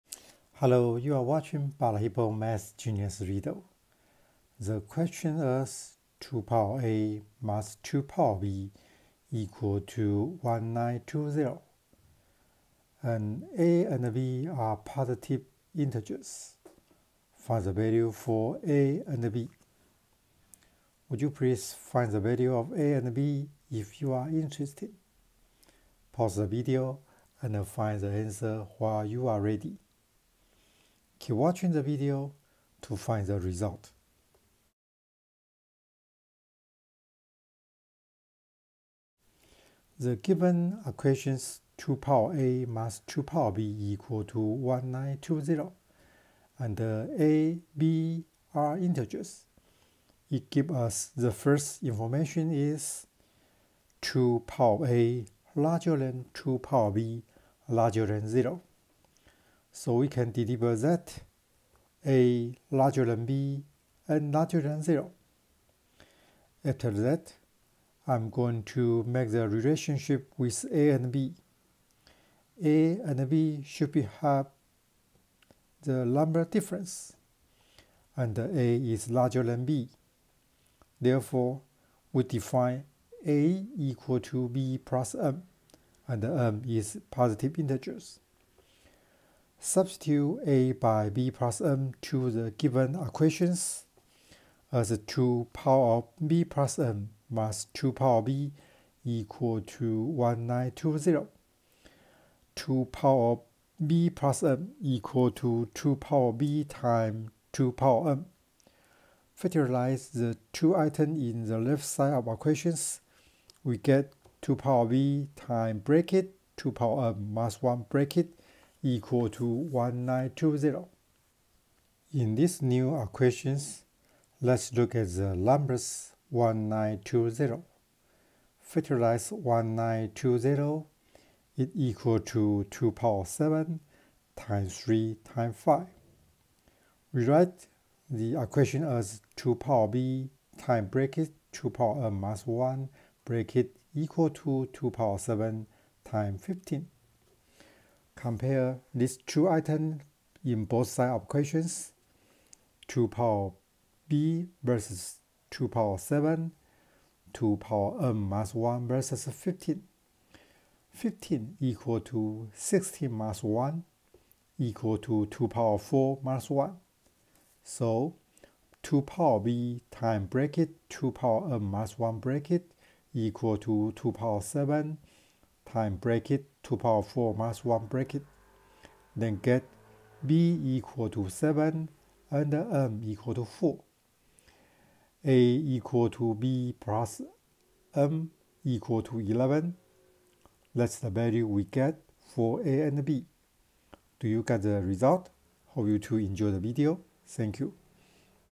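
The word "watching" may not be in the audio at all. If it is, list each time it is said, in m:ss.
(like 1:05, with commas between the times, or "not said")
0:01, 0:31.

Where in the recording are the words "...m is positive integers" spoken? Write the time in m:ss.
1:26.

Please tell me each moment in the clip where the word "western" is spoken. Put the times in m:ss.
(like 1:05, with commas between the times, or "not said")
not said.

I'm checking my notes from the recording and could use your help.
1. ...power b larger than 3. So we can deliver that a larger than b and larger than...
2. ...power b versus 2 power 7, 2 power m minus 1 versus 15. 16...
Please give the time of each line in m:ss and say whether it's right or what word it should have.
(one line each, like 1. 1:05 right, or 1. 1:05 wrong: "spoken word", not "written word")
1. 0:56 wrong: "0", not "3"
2. 2:33 wrong: "15", not "16".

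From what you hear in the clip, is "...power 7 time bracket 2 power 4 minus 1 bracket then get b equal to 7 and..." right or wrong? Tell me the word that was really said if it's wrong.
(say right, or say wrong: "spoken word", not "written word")
right.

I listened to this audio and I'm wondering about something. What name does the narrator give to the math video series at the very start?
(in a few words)
Balahippo Math Genius.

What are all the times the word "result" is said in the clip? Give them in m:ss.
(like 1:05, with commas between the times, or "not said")
0:33, 3:14.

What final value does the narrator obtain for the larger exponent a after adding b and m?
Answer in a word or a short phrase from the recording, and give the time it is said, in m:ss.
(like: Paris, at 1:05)
11, at 3:09.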